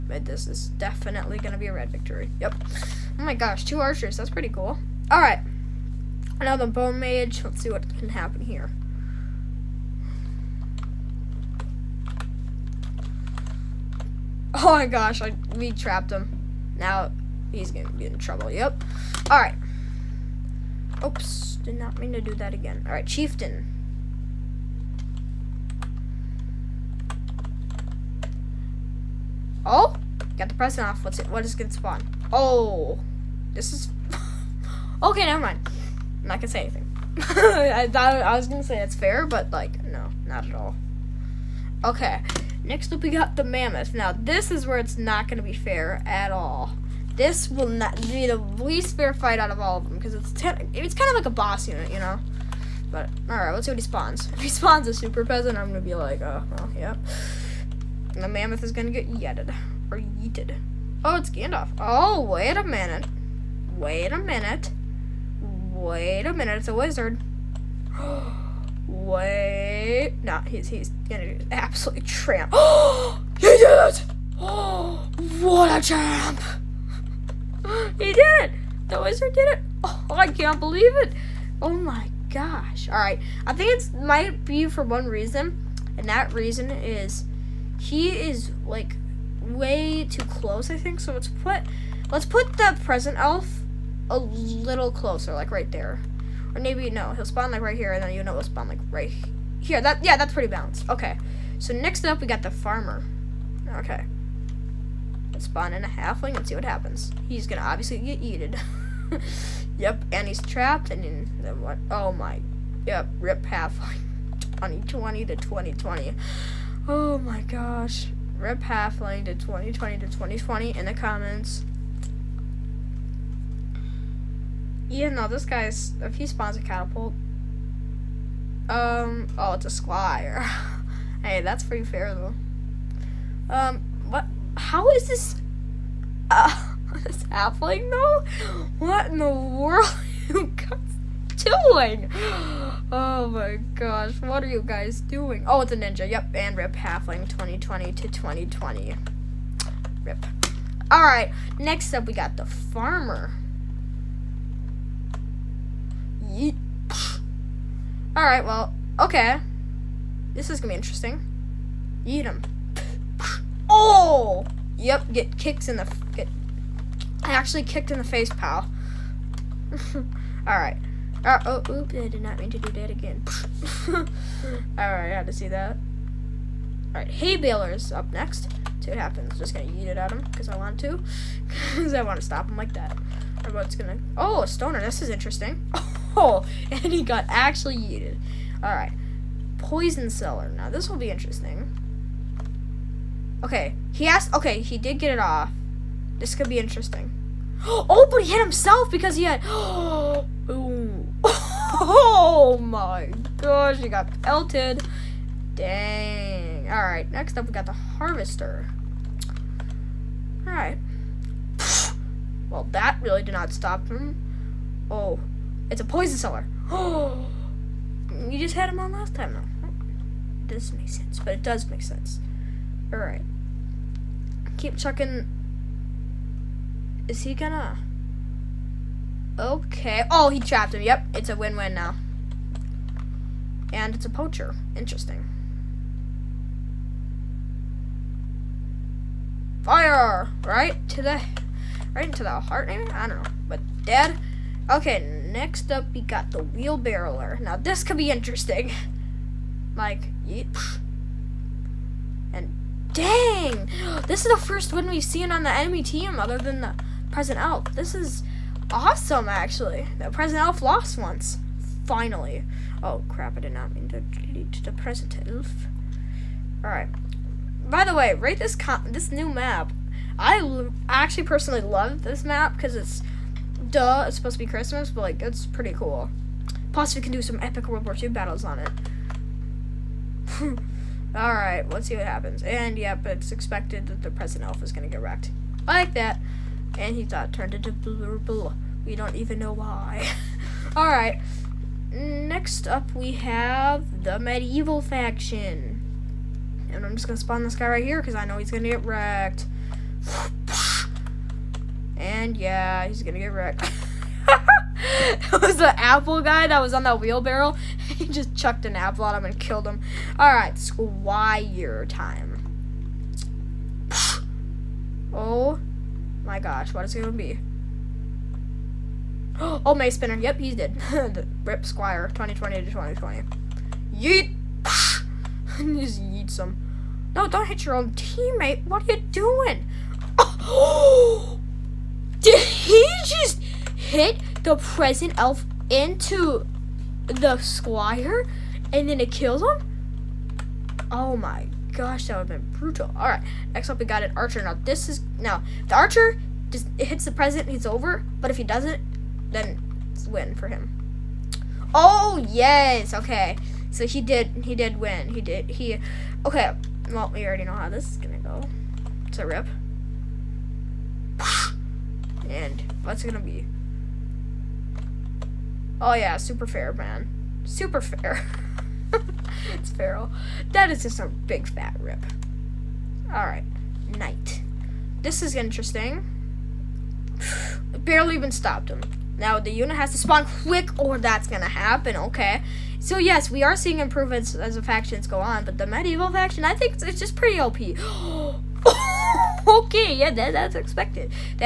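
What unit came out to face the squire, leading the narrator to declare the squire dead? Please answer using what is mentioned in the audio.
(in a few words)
Mace Spinner.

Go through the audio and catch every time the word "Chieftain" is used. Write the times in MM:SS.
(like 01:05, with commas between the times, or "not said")
00:23.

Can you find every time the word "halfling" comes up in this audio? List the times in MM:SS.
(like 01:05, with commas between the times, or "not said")
01:45, 01:53, 01:58, 02:17, 02:26.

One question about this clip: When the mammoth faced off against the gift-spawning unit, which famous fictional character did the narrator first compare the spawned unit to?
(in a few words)
Gandalf.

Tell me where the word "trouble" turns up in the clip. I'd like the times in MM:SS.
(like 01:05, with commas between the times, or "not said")
00:18.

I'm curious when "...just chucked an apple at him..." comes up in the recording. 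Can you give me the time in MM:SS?
05:08.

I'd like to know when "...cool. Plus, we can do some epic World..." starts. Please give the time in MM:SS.
04:35.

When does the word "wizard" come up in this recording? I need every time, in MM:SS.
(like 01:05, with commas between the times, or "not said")
01:06, 01:19.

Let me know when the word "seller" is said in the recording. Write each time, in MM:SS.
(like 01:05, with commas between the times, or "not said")
03:10, 03:36.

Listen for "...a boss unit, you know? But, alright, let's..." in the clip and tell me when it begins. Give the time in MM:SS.
00:51.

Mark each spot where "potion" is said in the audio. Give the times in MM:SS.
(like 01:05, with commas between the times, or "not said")
03:09, 03:35.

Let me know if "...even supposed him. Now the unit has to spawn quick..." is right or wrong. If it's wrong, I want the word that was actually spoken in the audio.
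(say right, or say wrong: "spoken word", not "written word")
wrong: "stopped", not "supposed".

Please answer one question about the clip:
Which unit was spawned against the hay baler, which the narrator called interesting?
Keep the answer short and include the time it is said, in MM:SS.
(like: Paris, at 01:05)
a stoner, at 03:04.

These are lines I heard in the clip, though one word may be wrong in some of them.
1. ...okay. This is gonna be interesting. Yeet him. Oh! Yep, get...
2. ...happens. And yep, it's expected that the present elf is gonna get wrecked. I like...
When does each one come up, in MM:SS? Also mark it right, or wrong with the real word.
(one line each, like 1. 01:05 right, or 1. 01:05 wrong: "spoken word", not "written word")
1. 02:38 right
2. 04:42 right.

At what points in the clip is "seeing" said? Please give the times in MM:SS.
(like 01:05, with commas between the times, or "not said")
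06:23.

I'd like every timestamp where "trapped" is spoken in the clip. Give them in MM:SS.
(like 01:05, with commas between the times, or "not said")
00:15, 01:50, 03:50.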